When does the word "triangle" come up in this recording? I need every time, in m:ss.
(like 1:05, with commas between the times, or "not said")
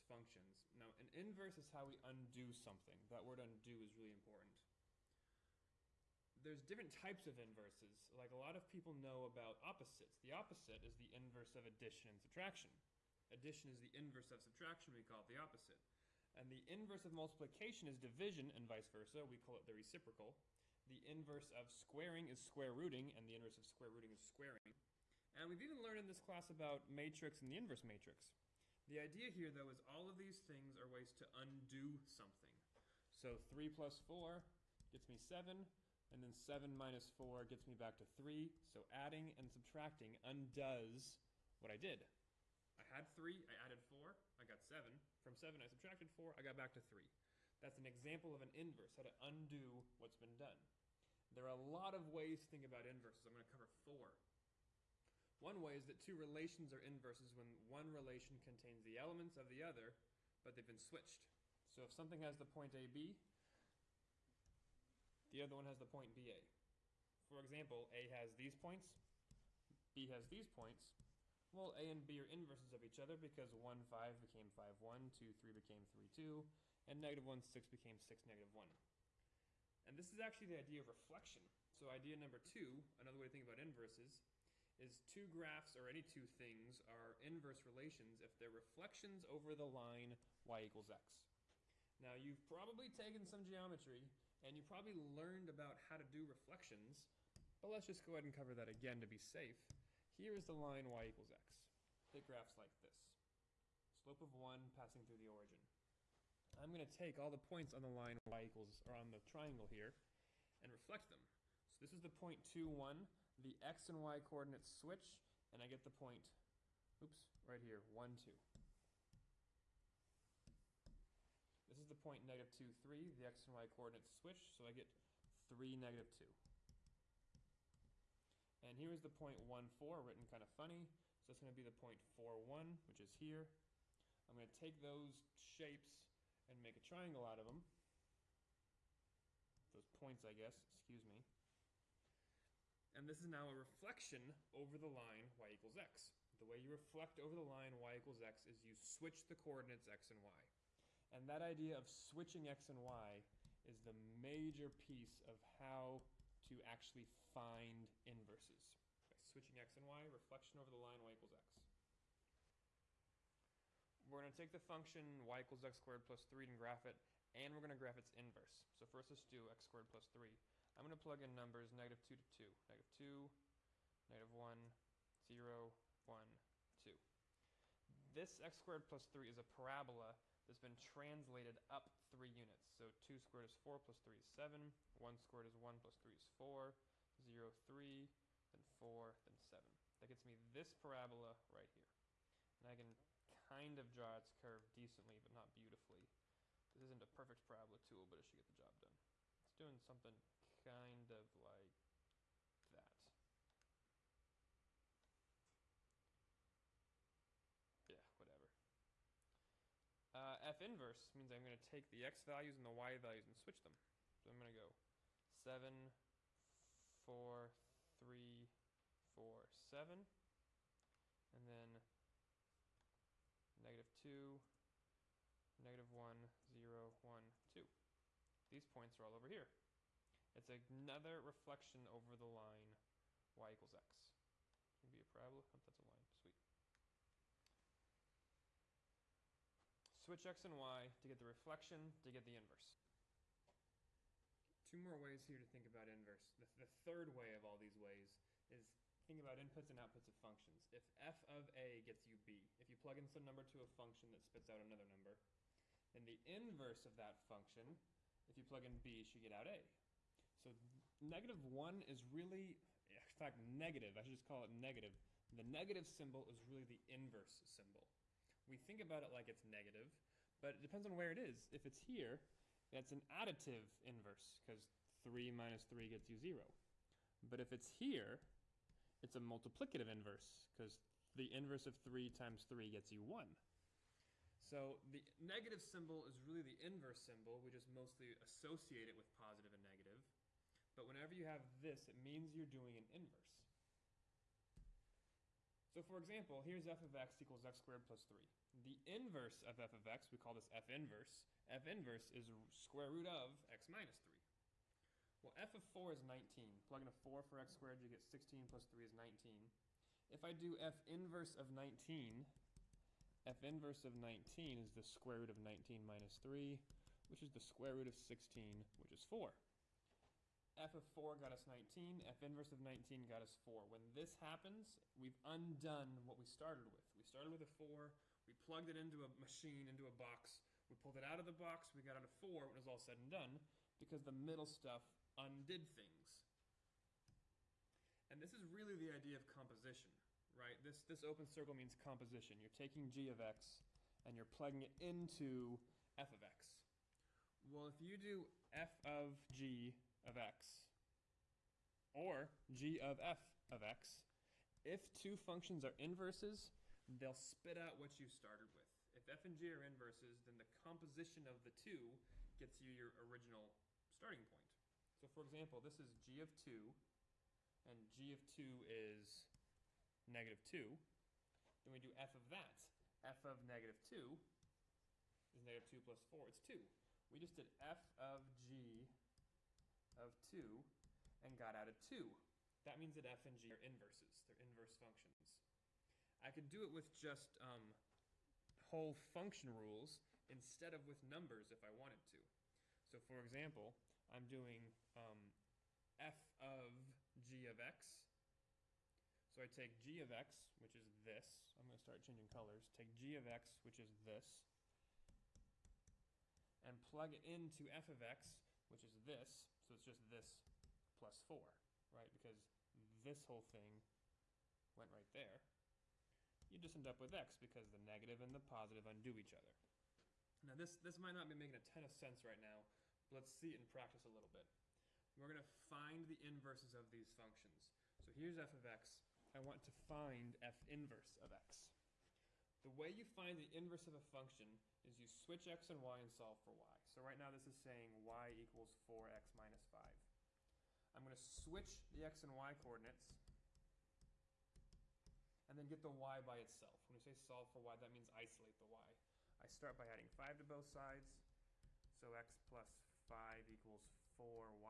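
1:49, 2:16.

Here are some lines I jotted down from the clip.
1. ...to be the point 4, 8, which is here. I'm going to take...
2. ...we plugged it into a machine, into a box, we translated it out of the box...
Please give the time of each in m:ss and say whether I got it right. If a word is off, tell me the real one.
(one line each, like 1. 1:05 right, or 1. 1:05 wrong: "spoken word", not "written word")
1. 2:11 wrong: "1", not "8"
2. 5:28 wrong: "pulled", not "translated".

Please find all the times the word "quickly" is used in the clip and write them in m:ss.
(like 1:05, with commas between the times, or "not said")
not said.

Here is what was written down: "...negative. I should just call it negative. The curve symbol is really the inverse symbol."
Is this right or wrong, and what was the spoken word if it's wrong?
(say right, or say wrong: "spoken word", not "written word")
wrong: "negative", not "curve".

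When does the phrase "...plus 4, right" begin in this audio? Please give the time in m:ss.
6:50.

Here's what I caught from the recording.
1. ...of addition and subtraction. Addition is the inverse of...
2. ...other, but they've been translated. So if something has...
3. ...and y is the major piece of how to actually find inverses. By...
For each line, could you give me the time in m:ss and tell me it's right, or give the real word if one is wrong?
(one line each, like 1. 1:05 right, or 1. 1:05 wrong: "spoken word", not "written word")
1. 0:11 right
2. 0:59 wrong: "switched", not "translated"
3. 2:32 right.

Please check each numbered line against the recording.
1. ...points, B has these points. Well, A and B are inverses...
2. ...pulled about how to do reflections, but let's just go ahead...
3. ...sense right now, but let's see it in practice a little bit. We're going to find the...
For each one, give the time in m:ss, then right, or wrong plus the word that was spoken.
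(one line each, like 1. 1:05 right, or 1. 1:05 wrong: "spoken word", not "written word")
1. 1:08 right
2. 1:34 wrong: "learned", not "pulled"
3. 7:01 right.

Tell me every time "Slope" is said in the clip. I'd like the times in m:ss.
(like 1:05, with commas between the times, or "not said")
1:43.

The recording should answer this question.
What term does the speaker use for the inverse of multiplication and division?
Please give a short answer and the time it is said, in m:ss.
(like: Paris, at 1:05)
reciprocal, at 0:19.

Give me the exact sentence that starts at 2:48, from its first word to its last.
So first let's do x squared plus 3.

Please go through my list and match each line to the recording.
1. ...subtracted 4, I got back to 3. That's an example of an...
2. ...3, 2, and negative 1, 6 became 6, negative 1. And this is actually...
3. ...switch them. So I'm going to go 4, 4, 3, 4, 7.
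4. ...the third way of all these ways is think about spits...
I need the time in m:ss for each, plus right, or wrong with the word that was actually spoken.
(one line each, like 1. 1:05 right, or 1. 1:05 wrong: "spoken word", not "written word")
1. 0:45 right
2. 1:15 right
3. 3:33 wrong: "7", not "4"
4. 4:06 wrong: "inputs", not "spits".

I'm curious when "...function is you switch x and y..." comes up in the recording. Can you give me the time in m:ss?
7:14.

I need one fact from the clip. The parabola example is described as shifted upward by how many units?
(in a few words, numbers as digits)
3 units.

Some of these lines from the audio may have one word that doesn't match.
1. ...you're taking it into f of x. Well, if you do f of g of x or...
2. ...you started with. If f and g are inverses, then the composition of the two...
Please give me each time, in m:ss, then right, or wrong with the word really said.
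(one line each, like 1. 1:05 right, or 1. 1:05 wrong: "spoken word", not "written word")
1. 5:44 wrong: "plugging", not "taking"
2. 5:57 right.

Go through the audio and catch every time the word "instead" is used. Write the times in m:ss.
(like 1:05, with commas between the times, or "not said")
6:30.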